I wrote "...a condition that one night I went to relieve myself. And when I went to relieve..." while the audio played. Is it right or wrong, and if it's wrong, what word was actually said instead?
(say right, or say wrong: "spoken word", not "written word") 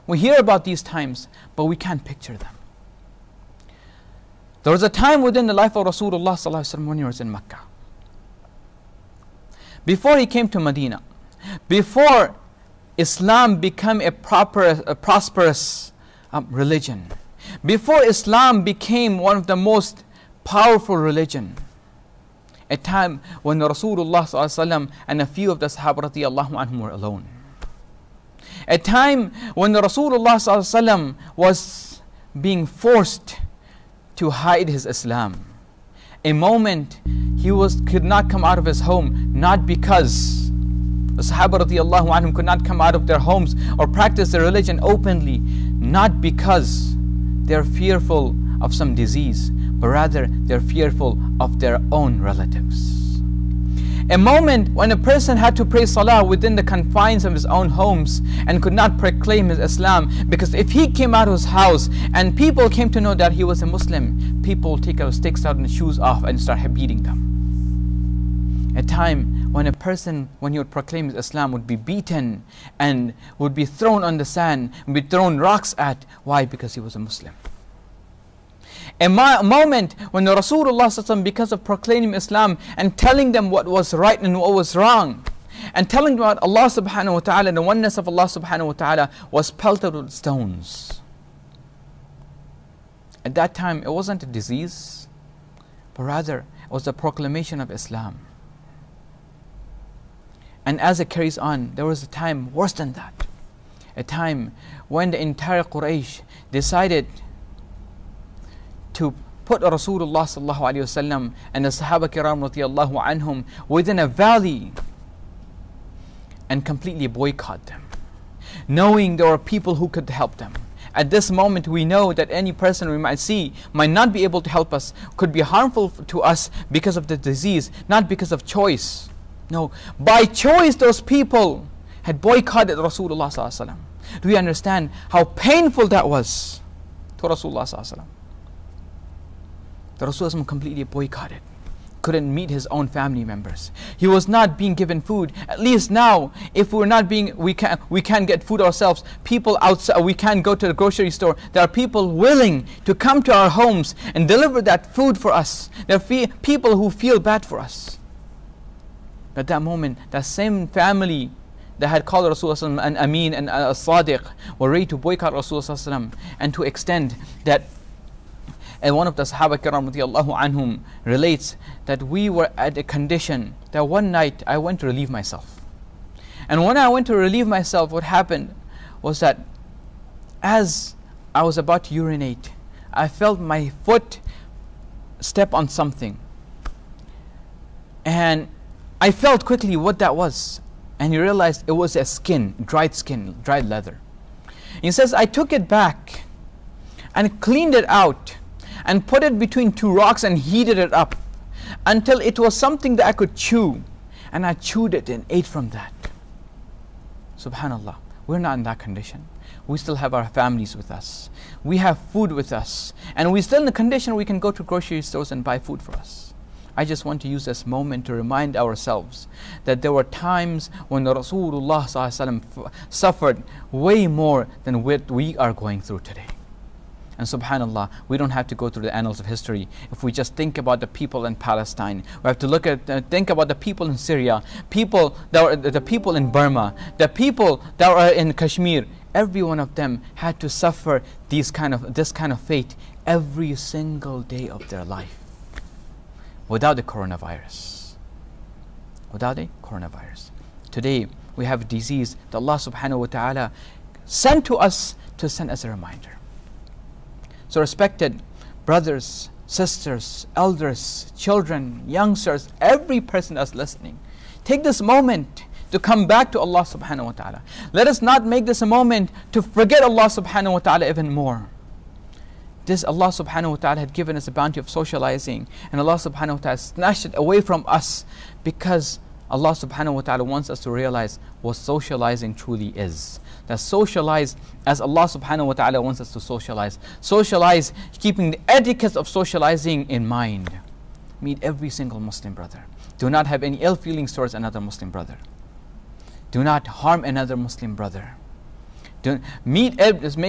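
right.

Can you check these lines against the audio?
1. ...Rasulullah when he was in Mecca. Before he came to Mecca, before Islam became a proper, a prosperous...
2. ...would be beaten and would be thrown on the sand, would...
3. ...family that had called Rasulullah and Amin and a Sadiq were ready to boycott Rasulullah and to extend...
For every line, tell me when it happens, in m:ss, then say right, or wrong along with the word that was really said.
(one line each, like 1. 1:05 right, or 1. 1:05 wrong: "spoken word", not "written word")
1. 0:05 wrong: "Medina", not "Mecca"
2. 1:11 right
3. 2:40 right.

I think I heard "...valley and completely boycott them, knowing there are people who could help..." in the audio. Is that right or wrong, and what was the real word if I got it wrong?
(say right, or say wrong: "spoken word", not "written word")
right.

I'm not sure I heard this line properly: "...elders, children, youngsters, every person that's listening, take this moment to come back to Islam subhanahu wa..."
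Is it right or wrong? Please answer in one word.
wrong.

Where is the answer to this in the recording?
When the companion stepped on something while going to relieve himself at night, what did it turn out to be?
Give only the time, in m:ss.
3:13.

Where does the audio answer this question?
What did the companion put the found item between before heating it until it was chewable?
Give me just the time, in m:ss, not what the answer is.
3:19.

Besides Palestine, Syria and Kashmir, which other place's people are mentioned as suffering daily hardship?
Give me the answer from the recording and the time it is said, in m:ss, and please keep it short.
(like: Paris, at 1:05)
Burma, at 3:56.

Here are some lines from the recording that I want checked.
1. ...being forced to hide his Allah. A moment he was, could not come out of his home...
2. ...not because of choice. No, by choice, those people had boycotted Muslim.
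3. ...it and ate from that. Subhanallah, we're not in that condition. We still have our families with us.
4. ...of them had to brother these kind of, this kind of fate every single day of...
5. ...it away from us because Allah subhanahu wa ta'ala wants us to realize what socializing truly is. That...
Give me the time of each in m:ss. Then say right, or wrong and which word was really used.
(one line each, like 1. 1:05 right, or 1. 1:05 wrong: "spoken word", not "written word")
1. 0:32 wrong: "Islam", not "Allah"
2. 2:07 wrong: "Rasulullah", not "Muslim"
3. 3:24 right
4. 3:59 wrong: "suffer", not "brother"
5. 4:37 right.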